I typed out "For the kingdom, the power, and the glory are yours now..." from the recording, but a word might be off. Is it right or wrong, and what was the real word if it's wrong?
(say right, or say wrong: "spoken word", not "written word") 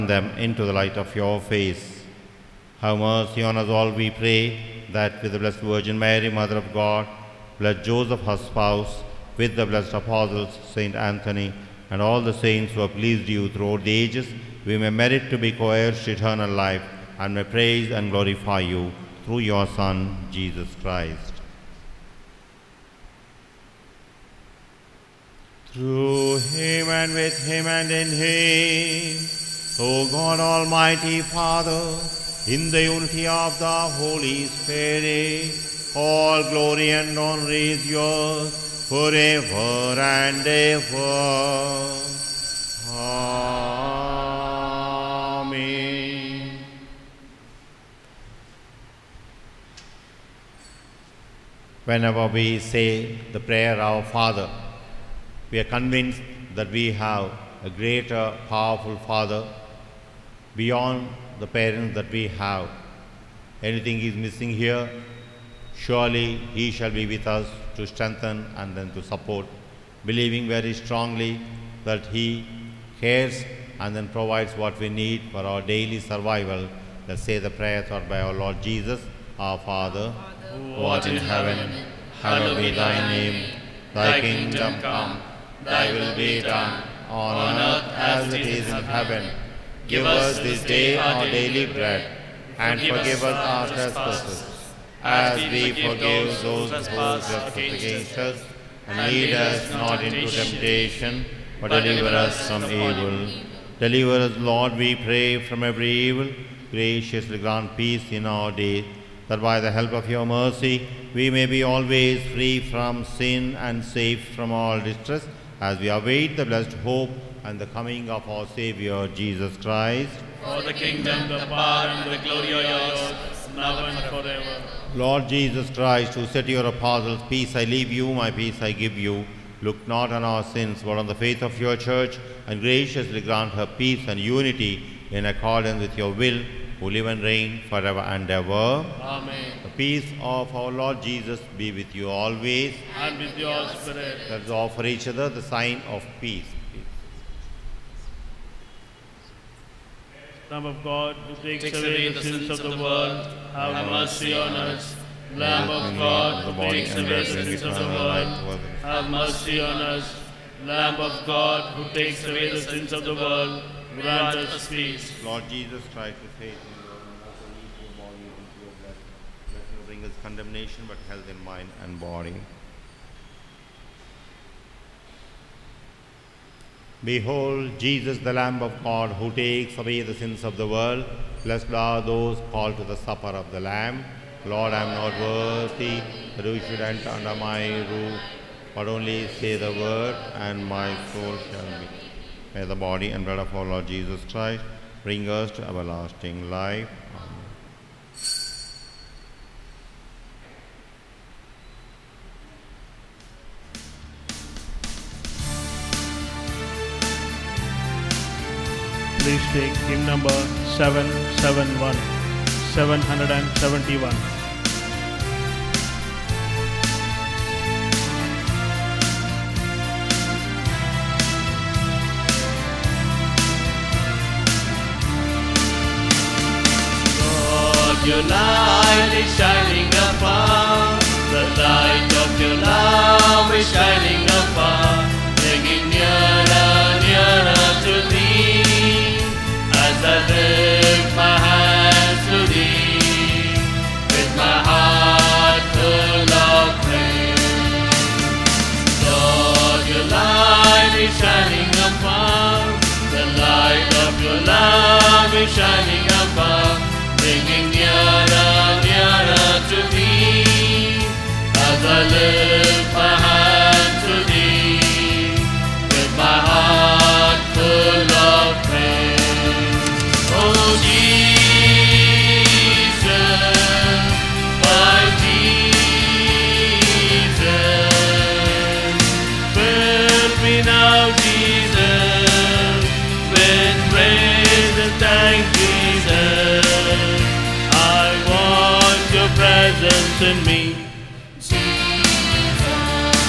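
right.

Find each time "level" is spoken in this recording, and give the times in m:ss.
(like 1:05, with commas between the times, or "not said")
not said.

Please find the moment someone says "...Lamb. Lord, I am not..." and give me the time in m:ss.
3:03.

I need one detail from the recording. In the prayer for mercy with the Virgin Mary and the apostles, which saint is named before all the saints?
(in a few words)
Saint Anthony.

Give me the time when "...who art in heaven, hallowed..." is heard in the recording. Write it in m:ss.
1:20.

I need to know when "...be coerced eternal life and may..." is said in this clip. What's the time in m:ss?
0:15.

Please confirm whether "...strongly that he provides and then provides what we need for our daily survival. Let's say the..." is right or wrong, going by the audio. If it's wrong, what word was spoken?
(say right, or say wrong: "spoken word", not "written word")
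wrong: "cares", not "provides".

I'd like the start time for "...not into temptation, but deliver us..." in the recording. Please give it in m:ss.
1:39.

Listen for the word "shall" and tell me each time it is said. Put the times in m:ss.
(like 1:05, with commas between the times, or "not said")
1:06, 3:11.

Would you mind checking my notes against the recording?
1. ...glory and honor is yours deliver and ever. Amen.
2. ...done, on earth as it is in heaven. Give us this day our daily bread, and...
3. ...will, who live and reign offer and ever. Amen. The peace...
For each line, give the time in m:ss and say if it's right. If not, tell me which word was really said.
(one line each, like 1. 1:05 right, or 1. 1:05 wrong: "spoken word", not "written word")
1. 0:36 wrong: "forever", not "deliver"
2. 1:26 right
3. 2:16 wrong: "forever", not "offer".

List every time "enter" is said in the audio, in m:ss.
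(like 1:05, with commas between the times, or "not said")
3:06.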